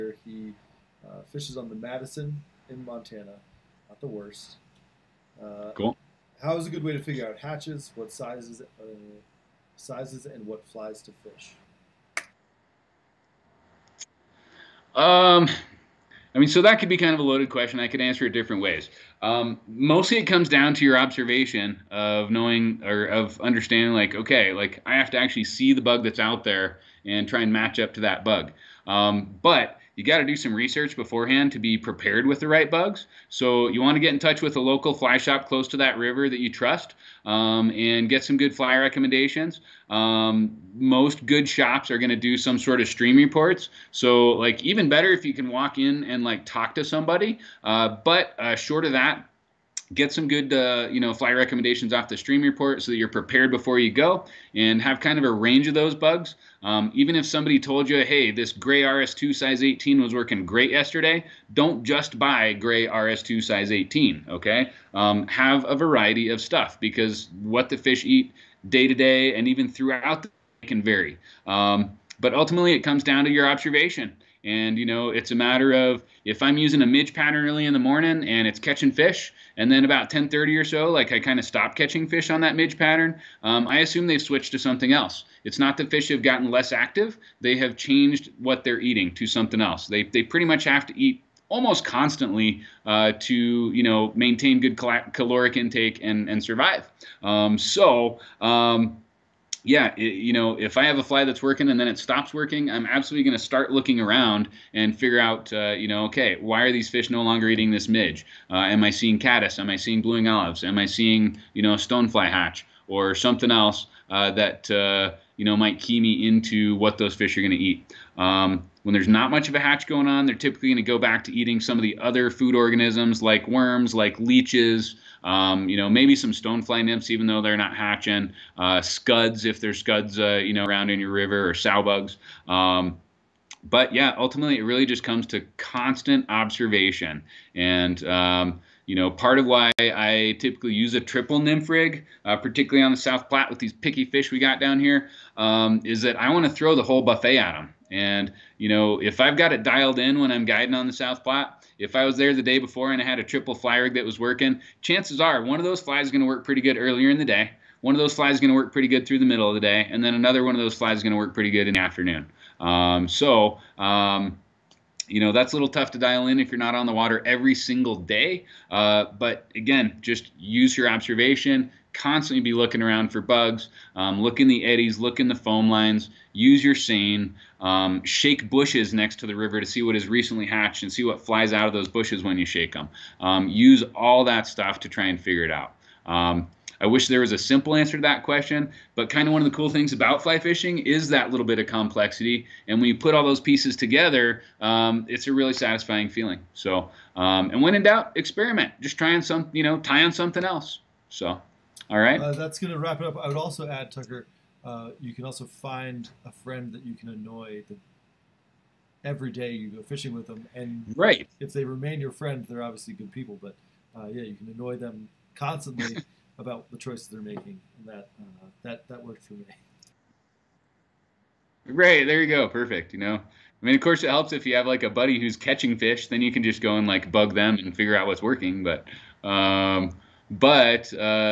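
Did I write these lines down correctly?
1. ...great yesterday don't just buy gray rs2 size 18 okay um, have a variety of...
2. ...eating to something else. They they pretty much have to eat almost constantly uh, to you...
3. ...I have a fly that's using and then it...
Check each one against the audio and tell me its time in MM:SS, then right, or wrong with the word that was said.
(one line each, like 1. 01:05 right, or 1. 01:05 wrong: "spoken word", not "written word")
1. 01:00 right
2. 01:28 right
3. 01:40 wrong: "working", not "using".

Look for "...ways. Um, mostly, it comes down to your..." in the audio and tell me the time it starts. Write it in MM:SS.
00:18.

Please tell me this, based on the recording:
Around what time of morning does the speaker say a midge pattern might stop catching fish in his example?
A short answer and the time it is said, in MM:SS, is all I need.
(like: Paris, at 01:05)
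10:30, at 01:20.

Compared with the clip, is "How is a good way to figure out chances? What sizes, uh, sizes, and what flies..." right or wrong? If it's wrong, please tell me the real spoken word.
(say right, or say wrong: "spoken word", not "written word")
wrong: "hatches", not "chances".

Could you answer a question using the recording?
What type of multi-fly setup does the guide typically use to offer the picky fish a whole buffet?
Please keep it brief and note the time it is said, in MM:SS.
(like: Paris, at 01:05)
Triple nymph rig, at 02:21.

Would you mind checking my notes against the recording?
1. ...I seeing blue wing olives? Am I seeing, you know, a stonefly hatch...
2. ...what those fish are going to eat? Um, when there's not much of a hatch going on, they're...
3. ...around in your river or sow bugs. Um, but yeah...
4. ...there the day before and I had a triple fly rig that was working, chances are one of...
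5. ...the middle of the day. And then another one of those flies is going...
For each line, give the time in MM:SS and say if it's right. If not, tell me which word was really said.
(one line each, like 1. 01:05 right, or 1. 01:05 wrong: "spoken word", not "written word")
1. 01:49 right
2. 01:56 right
3. 02:10 right
4. 02:32 right
5. 02:39 right.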